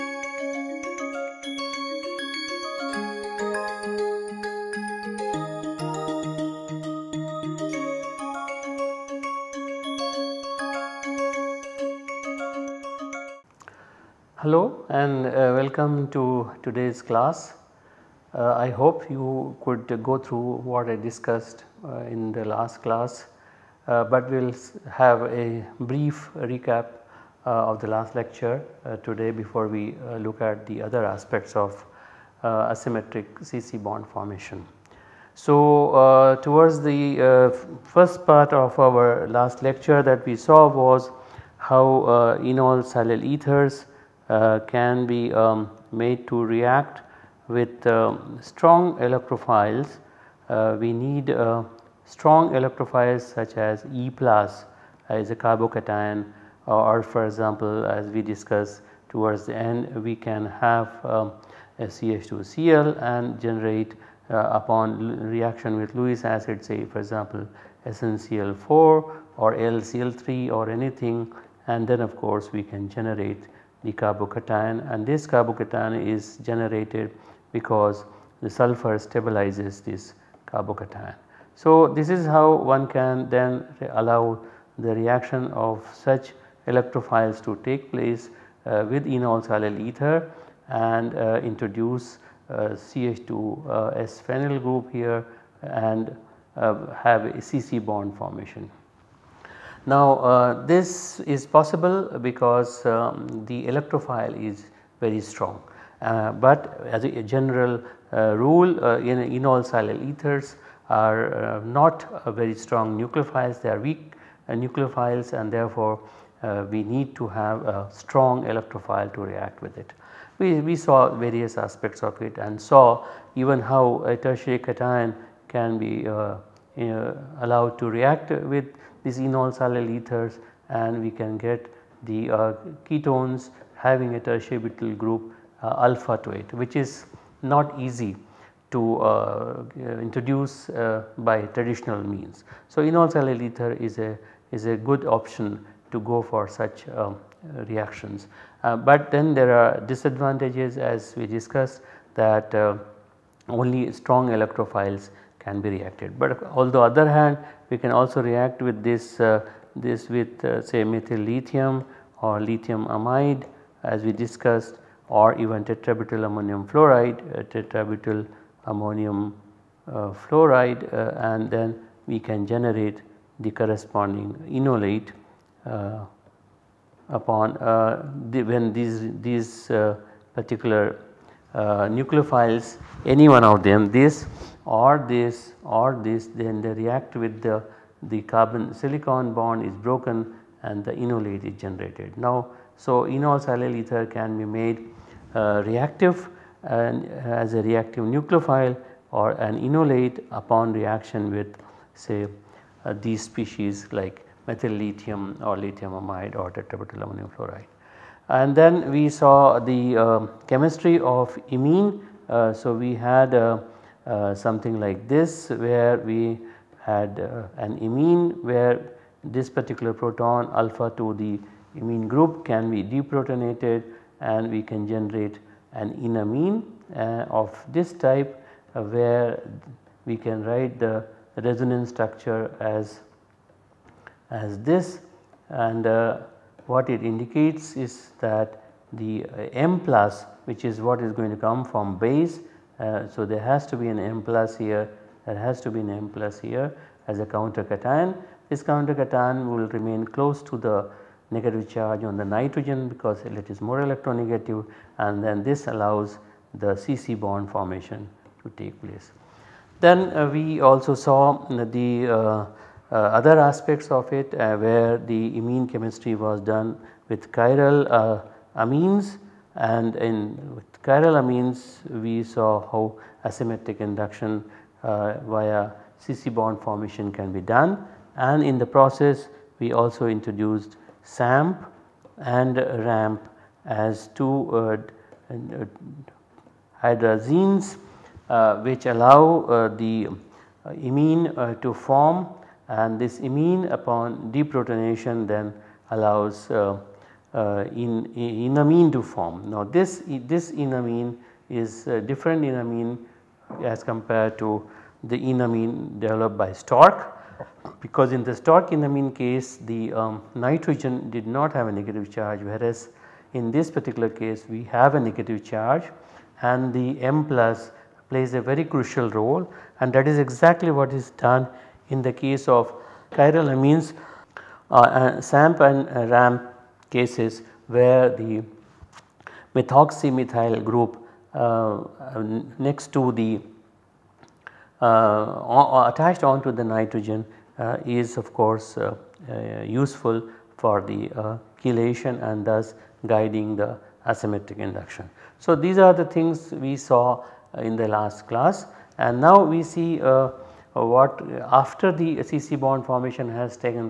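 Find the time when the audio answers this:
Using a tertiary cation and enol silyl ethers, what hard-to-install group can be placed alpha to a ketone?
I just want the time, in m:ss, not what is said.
2:14.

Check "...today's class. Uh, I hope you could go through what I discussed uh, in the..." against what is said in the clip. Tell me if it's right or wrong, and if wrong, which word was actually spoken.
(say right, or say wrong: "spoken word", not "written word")
right.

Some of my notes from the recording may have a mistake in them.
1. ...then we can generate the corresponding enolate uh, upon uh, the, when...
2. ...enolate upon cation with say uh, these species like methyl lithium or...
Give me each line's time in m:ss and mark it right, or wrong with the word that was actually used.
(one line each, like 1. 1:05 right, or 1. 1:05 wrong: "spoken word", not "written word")
1. 2:51 right
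2. 3:19 wrong: "reaction", not "cation".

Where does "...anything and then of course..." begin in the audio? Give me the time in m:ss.
1:10.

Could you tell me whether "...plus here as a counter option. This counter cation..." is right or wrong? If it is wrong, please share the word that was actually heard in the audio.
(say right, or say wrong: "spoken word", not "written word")
wrong: "cation", not "option".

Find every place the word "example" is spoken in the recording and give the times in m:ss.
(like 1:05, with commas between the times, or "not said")
0:57, 1:06.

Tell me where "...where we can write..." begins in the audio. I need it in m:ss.
3:48.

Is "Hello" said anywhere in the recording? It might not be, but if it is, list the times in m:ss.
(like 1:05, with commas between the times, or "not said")
0:14.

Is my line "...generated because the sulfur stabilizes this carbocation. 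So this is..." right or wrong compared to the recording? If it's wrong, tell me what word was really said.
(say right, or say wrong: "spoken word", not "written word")
right.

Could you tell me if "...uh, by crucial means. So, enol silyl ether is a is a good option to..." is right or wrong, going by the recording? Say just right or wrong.
wrong.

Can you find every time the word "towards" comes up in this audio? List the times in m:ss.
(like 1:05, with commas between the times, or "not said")
0:36, 0:59.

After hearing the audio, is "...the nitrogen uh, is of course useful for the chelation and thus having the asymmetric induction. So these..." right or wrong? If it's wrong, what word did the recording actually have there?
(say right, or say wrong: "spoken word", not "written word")
wrong: "guiding", not "having".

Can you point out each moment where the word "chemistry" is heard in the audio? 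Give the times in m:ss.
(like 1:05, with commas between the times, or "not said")
3:30, 4:25.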